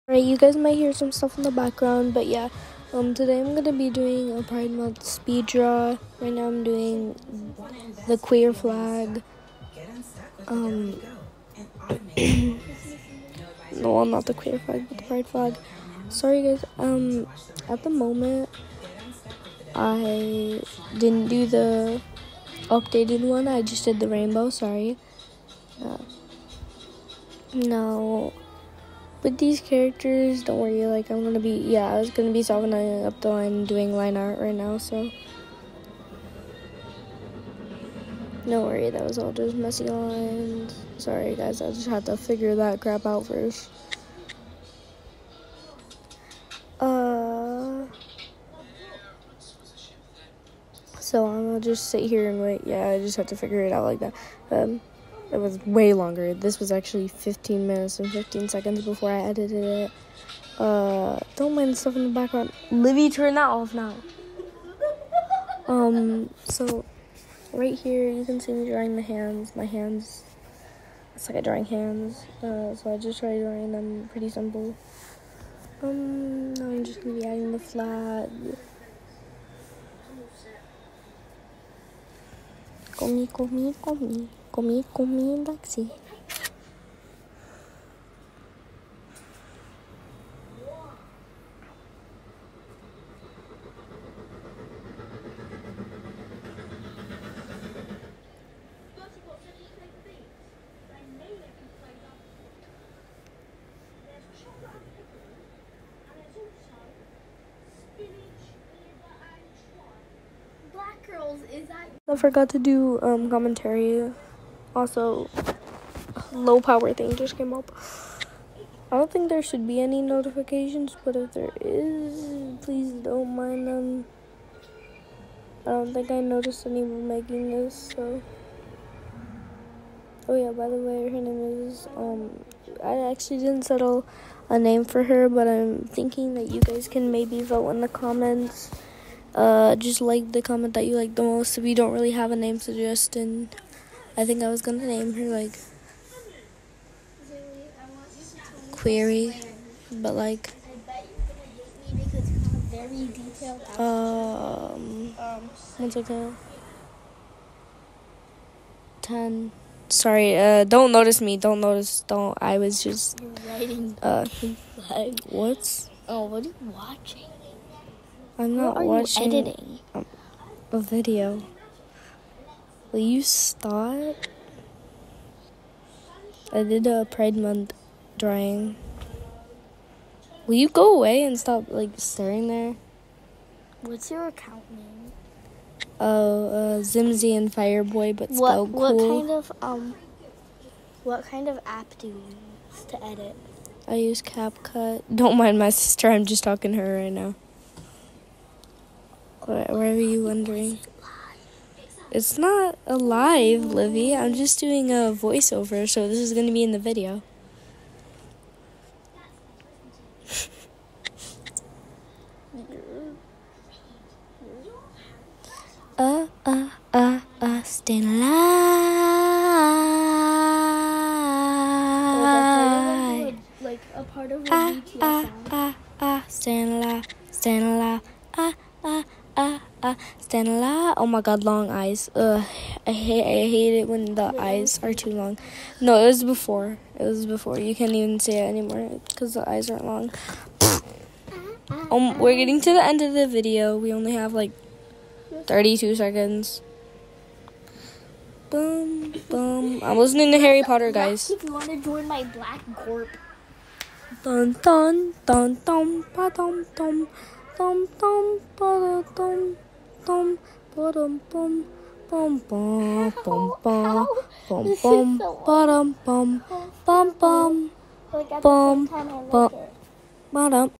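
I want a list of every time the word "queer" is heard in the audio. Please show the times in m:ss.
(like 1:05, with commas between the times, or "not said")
0:08, 0:14.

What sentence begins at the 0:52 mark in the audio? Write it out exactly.
Yeah, I just have to figure it out like that.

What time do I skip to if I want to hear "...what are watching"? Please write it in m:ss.
2:48.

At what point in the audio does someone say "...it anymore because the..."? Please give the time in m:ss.
3:58.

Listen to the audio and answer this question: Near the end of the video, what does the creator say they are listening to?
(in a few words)
Harry Potter.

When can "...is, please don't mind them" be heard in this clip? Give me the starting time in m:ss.
2:01.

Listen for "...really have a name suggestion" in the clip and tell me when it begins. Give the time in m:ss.
2:21.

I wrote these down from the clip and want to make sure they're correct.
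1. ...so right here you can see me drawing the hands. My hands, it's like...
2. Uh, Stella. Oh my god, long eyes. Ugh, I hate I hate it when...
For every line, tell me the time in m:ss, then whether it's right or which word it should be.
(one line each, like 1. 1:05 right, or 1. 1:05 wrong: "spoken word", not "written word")
1. 1:06 right
2. 3:49 right.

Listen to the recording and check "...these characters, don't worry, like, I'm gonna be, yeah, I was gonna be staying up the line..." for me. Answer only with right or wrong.
wrong.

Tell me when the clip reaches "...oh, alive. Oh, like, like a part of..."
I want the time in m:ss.
3:38.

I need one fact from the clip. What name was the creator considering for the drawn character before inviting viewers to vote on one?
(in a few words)
Query.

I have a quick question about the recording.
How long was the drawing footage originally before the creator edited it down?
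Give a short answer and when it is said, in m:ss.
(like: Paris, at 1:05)
15 minutes and 15 seconds, at 0:57.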